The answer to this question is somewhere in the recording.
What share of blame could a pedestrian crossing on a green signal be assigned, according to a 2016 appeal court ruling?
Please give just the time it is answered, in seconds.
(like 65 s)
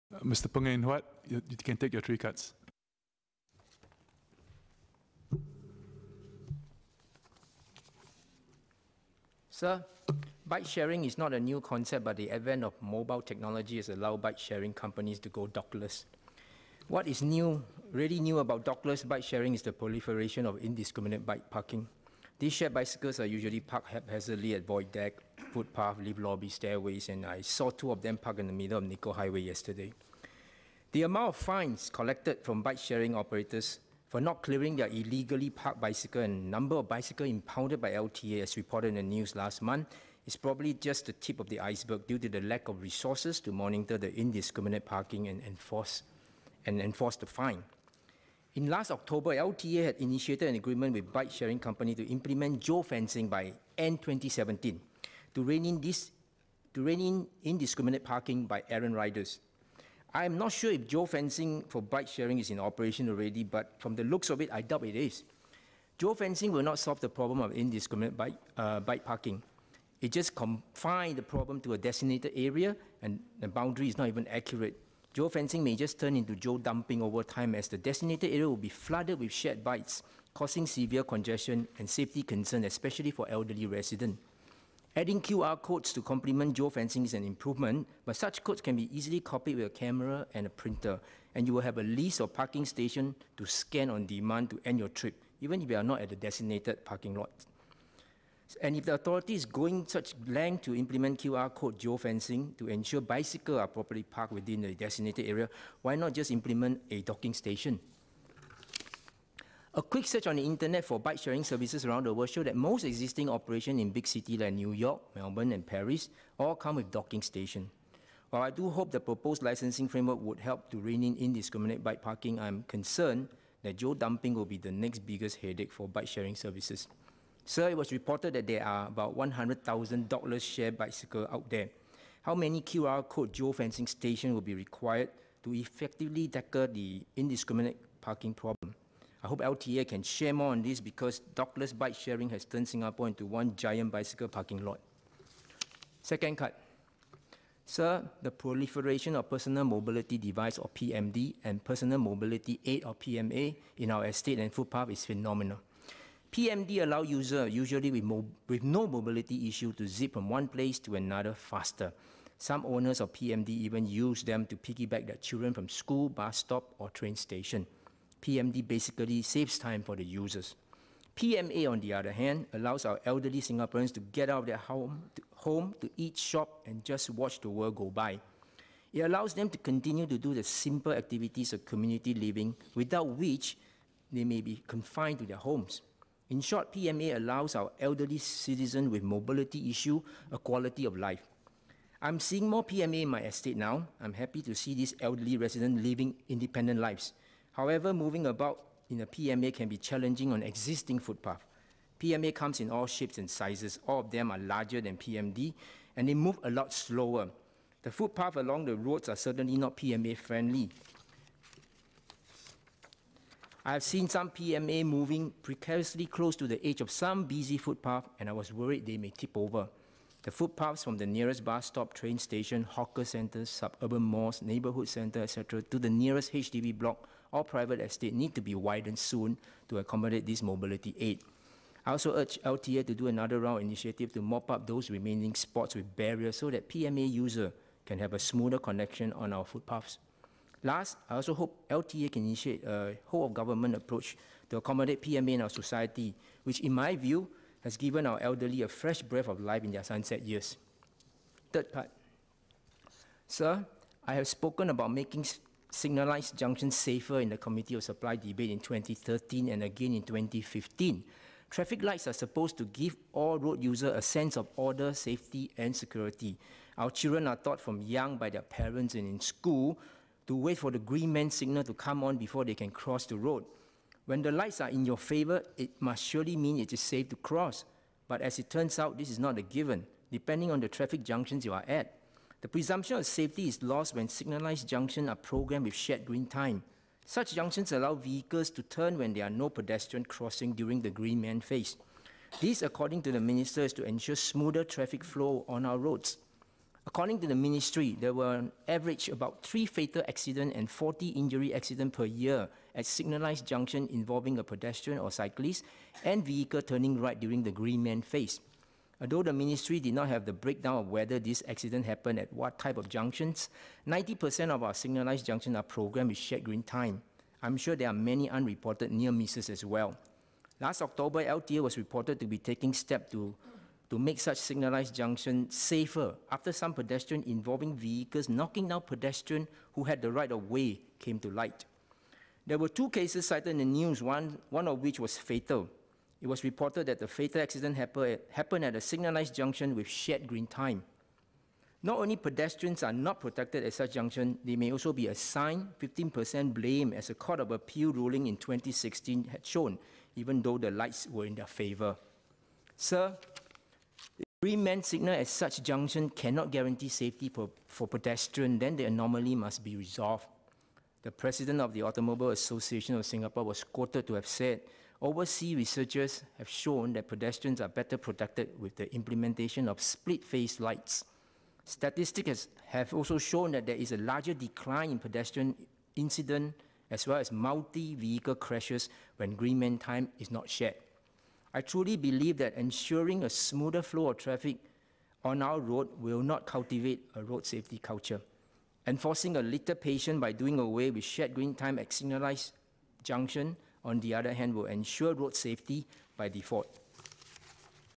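345 s.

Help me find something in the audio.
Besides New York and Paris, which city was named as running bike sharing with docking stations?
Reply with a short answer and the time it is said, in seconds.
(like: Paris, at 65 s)
Melbourne, at 115 s.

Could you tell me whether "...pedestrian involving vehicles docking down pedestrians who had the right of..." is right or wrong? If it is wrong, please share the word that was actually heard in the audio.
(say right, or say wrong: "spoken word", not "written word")
wrong: "knocking", not "docking".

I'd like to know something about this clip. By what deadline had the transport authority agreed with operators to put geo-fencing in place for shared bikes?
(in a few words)
end 2017.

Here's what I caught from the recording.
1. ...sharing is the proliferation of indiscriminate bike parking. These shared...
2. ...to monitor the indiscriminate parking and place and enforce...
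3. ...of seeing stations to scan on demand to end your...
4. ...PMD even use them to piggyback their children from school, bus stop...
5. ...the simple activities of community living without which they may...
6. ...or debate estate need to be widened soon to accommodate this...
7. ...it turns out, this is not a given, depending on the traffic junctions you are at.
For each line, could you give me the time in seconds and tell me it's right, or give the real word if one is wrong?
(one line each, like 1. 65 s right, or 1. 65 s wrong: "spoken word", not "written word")
1. 19 s right
2. 43 s wrong: "enforce", not "place"
3. 92 s wrong: "parking", not "seeing"
4. 163 s right
5. 180 s right
6. 227 s wrong: "private", not "debate"
7. 278 s right.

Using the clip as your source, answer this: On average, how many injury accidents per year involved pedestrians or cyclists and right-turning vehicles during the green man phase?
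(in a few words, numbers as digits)
40.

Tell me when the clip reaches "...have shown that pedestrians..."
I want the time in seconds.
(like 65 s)
366 s.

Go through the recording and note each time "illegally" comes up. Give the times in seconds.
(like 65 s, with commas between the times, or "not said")
34 s.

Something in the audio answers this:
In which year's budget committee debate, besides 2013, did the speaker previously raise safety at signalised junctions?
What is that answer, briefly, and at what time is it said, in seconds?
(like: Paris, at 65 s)
2015, at 260 s.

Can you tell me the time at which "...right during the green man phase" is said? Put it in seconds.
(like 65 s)
306 s.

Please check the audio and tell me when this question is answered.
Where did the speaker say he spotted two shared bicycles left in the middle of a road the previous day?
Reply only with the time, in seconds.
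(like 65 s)
28 s.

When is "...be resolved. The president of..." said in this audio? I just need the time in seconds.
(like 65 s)
359 s.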